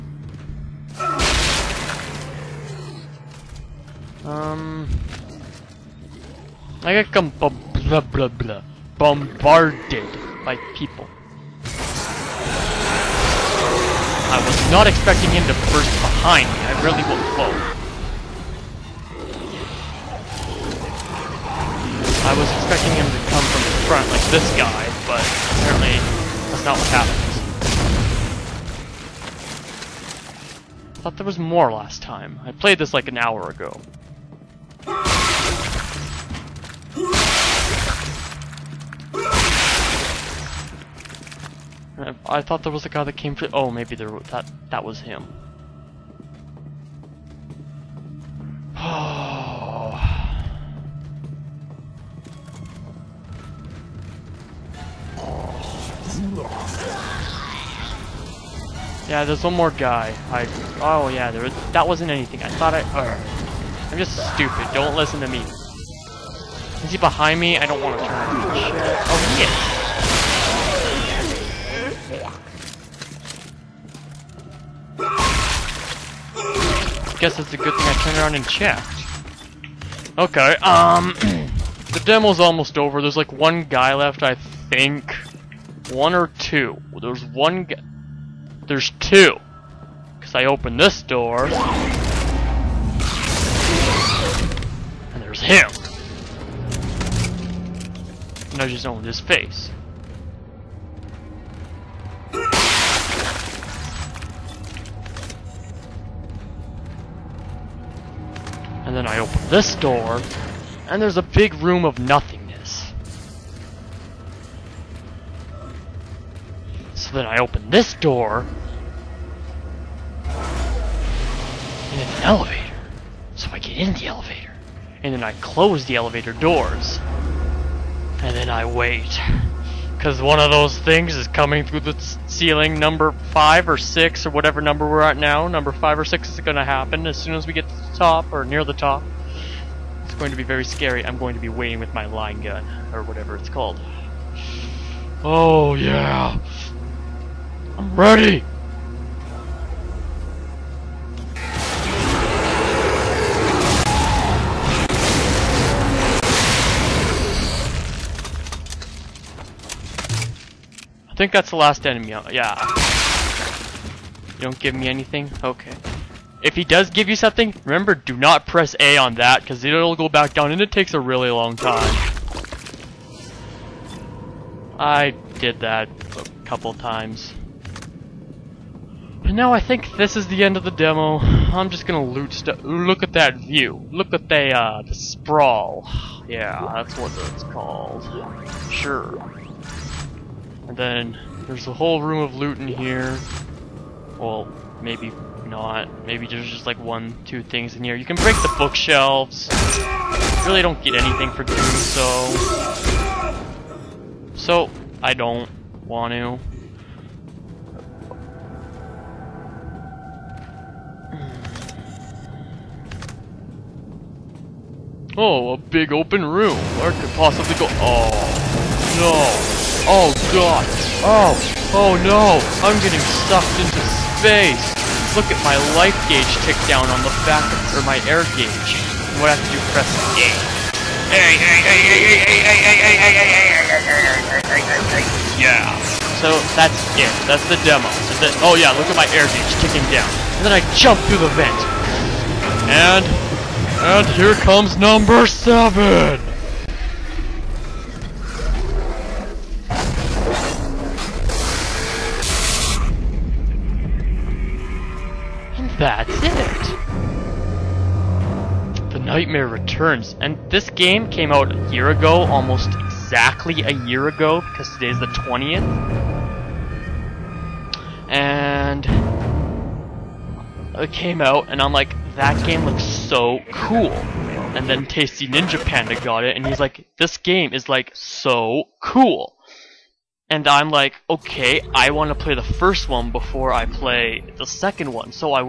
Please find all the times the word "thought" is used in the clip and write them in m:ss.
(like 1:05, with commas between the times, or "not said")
0:31, 0:42, 1:02.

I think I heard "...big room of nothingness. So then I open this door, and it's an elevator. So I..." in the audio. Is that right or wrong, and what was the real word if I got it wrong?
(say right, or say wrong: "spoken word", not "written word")
right.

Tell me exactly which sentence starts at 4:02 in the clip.
And and here comes number seven!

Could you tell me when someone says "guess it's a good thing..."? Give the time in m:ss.
1:17.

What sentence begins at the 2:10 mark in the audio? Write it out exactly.
Because one of those things is coming through the ceiling number 5 or 6 or whatever number we're at now.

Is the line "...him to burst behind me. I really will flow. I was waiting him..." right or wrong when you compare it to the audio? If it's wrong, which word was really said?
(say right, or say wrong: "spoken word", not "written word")
wrong: "expecting", not "waiting".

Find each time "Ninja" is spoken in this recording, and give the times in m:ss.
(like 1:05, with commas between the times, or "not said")
4:35.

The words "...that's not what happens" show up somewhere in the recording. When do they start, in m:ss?
0:26.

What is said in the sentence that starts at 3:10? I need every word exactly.
And then there's a whole room of loot in here.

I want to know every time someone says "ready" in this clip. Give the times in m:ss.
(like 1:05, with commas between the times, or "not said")
2:27.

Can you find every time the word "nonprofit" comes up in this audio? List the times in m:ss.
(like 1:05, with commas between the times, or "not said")
not said.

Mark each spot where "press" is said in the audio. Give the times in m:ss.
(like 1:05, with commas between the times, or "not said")
2:48, 3:49.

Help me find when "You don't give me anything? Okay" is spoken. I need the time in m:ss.
2:44.